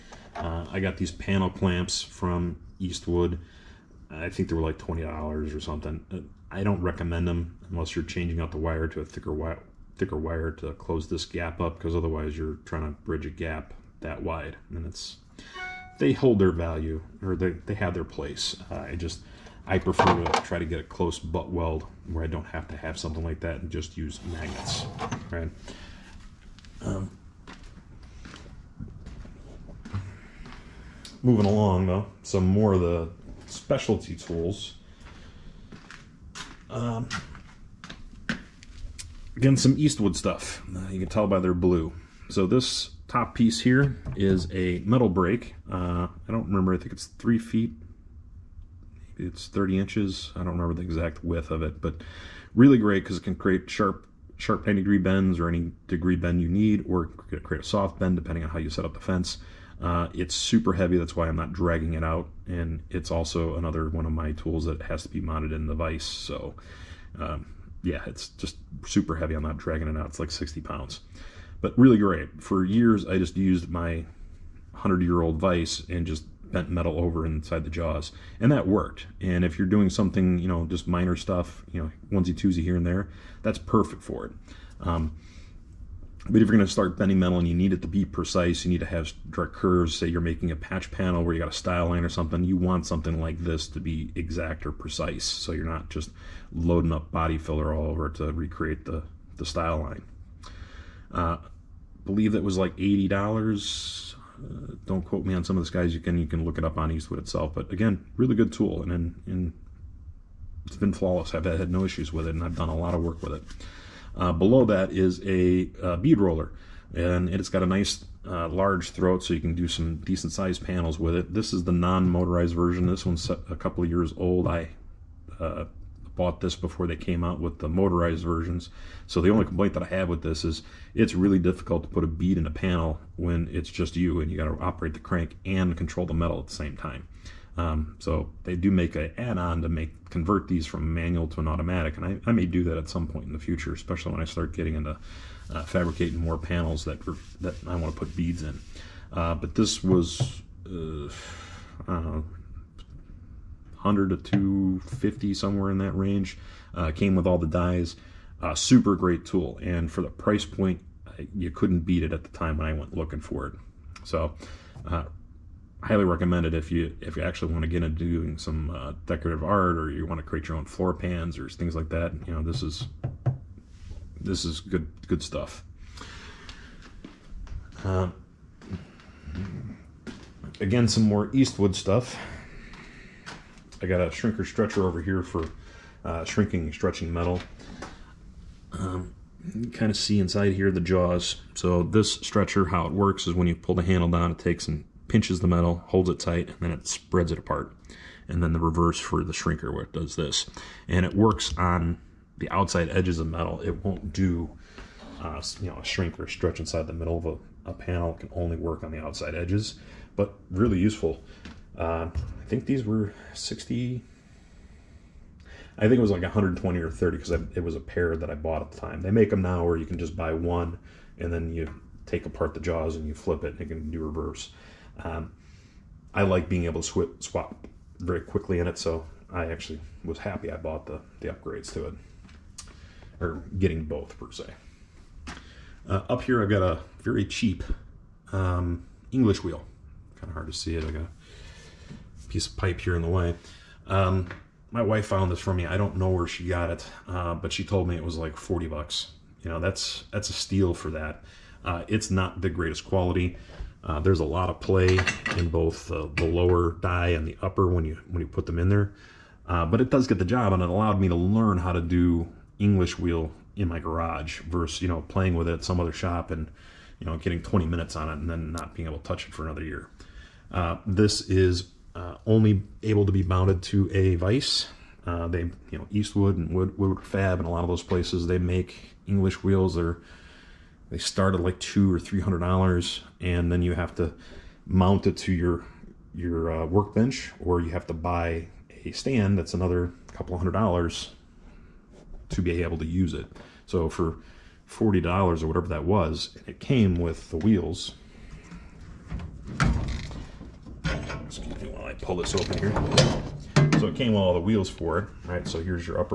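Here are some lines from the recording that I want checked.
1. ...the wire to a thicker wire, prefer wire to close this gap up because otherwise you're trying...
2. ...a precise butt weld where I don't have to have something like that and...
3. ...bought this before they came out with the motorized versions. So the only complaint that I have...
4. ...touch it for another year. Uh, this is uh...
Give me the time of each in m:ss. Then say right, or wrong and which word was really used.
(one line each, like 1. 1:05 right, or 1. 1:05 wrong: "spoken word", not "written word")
1. 0:08 wrong: "thicker", not "prefer"
2. 0:20 wrong: "close", not "precise"
3. 2:06 right
4. 4:29 right.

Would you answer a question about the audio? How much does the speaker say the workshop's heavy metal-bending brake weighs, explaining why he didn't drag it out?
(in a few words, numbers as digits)
60 pounds.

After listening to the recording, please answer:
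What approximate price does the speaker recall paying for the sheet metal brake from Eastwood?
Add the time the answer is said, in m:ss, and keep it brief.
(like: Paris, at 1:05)
$80, at 1:42.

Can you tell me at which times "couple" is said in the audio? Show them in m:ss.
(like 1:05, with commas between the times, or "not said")
2:03, 4:50.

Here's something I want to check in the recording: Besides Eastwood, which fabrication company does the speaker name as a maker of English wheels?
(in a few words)
Woodward Fab.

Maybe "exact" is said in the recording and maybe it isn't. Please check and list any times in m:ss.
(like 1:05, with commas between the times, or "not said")
0:50, 1:34.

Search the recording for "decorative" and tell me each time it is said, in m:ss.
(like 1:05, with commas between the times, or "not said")
2:49.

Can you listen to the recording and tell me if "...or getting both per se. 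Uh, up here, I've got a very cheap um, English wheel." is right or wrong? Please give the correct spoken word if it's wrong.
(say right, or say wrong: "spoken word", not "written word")
right.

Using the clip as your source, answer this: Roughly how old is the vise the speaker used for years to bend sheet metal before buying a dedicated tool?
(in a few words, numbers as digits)
100 years old.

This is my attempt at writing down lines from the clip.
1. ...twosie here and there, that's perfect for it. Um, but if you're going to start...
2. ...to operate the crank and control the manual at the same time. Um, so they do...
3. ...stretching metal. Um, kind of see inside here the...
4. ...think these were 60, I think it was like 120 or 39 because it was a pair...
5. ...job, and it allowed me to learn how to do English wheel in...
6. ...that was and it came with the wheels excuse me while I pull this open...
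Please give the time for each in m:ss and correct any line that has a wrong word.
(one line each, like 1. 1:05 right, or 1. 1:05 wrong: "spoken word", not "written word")
1. 1:22 right
2. 2:14 wrong: "metal", not "manual"
3. 3:06 right
4. 3:32 wrong: "30", not "39"
5. 4:20 right
6. 4:55 right.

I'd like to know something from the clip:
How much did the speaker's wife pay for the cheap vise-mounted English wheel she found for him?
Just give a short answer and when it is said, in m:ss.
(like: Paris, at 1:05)
$40, at 4:08.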